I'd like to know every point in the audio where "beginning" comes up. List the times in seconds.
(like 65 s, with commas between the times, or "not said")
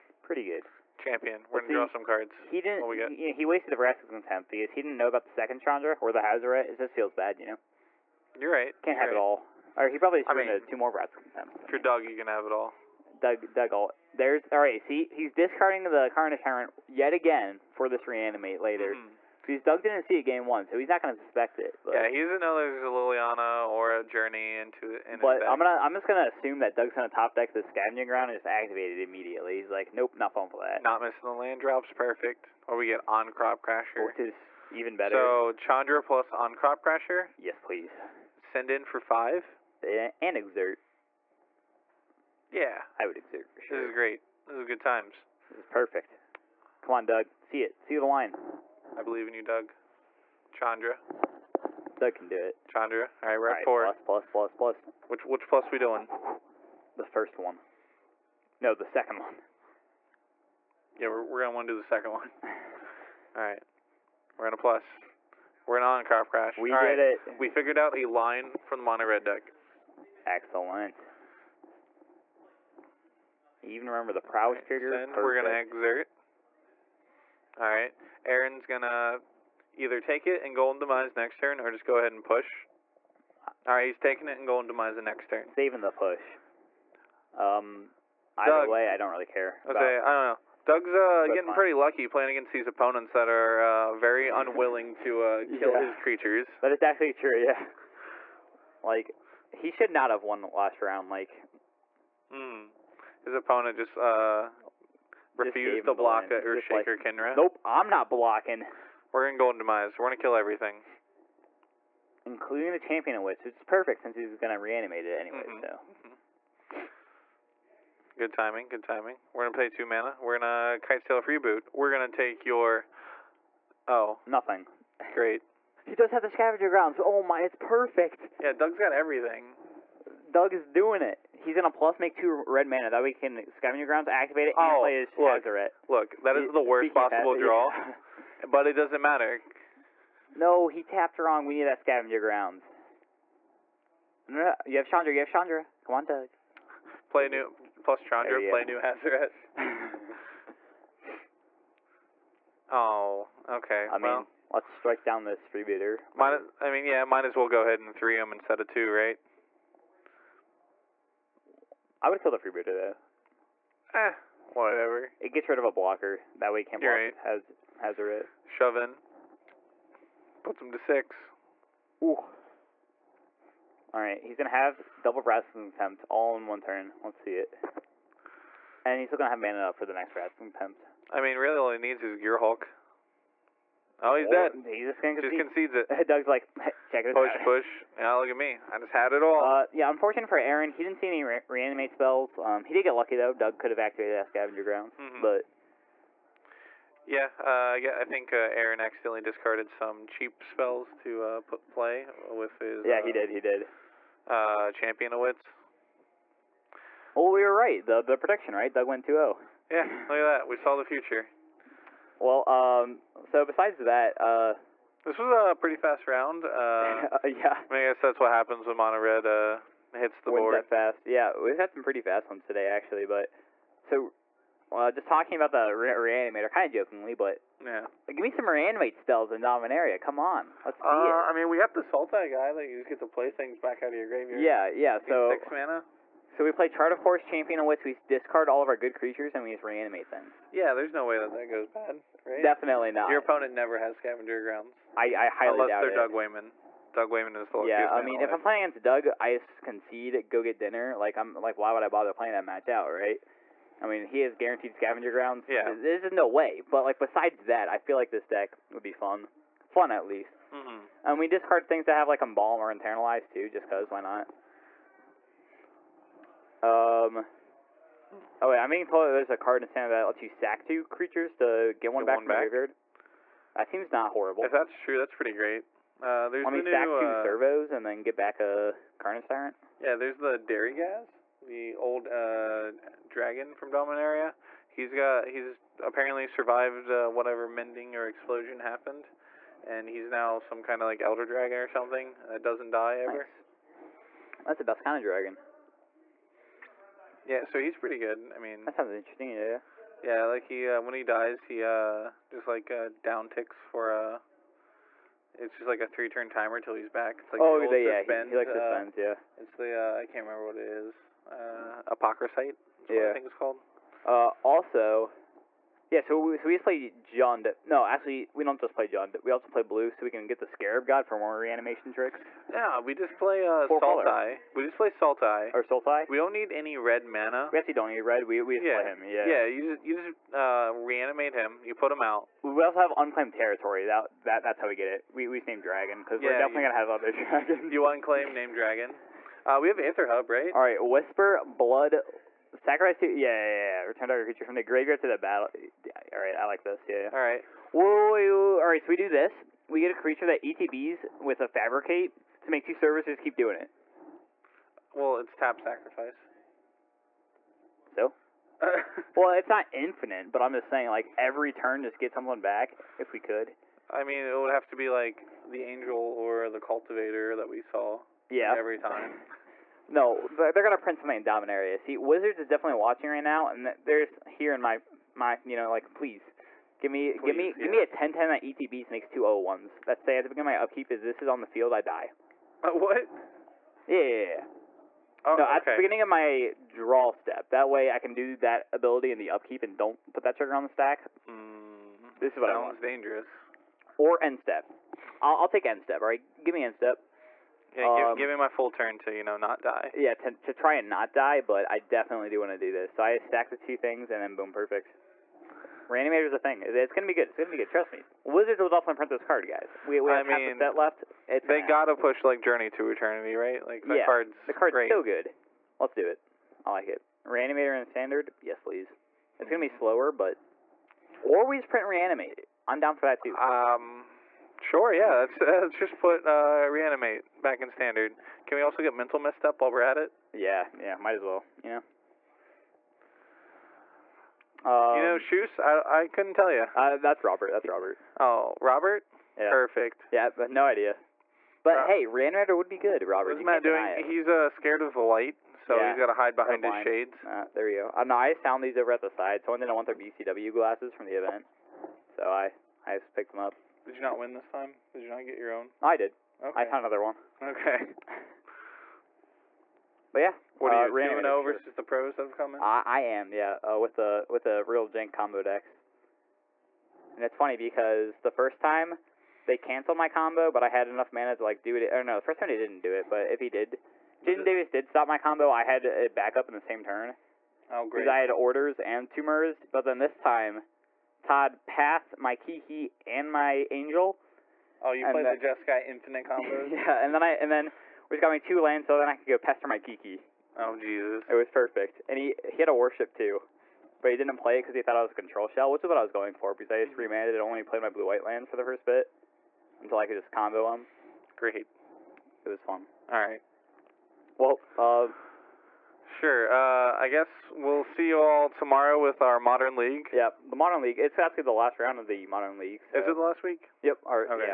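380 s, 385 s.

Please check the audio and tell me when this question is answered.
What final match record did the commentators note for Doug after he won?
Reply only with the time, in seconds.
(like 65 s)
209 s.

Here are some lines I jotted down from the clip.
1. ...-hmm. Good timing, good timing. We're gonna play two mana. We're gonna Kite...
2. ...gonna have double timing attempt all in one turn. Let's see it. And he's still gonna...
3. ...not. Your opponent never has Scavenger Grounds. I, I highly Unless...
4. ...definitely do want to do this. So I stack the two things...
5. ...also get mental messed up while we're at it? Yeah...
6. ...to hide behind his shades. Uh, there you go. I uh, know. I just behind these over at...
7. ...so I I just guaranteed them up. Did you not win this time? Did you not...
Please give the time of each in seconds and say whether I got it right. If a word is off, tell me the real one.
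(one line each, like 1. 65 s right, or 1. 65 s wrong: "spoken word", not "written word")
1. 116 s right
2. 174 s wrong: "wrestling", not "timing"
3. 242 s right
4. 401 s right
5. 428 s right
6. 446 s wrong: "found", not "behind"
7. 452 s wrong: "picked", not "guaranteed".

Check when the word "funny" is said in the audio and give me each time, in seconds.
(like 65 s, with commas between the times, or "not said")
467 s.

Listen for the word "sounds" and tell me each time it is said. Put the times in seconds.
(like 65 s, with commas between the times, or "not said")
298 s, 392 s.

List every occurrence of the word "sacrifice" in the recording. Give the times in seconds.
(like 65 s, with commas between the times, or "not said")
342 s, 355 s.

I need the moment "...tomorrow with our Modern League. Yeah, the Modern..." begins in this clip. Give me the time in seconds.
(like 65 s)
508 s.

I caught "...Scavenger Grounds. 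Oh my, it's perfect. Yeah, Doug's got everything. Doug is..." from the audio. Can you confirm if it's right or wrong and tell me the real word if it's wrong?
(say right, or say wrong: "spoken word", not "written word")
right.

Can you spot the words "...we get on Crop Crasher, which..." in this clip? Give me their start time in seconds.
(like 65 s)
32 s.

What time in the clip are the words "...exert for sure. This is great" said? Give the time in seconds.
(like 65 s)
43 s.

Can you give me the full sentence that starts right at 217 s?
I, mean, I guess that's what happens when Mono Red uh, hits the Wins board.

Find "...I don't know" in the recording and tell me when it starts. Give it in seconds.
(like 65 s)
89 s.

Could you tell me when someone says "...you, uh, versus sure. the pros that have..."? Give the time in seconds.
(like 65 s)
460 s.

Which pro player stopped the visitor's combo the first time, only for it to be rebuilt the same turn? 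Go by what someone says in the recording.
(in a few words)
Jaden Davis.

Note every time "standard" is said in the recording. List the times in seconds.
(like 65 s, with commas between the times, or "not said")
269 s, 417 s, 427 s.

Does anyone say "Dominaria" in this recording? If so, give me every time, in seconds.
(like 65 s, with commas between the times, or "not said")
229 s, 283 s, 371 s.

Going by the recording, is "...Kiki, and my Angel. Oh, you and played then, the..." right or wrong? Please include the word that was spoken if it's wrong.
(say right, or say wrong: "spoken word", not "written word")
right.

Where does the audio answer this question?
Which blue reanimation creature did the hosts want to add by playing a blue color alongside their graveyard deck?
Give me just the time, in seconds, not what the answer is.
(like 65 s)
320 s.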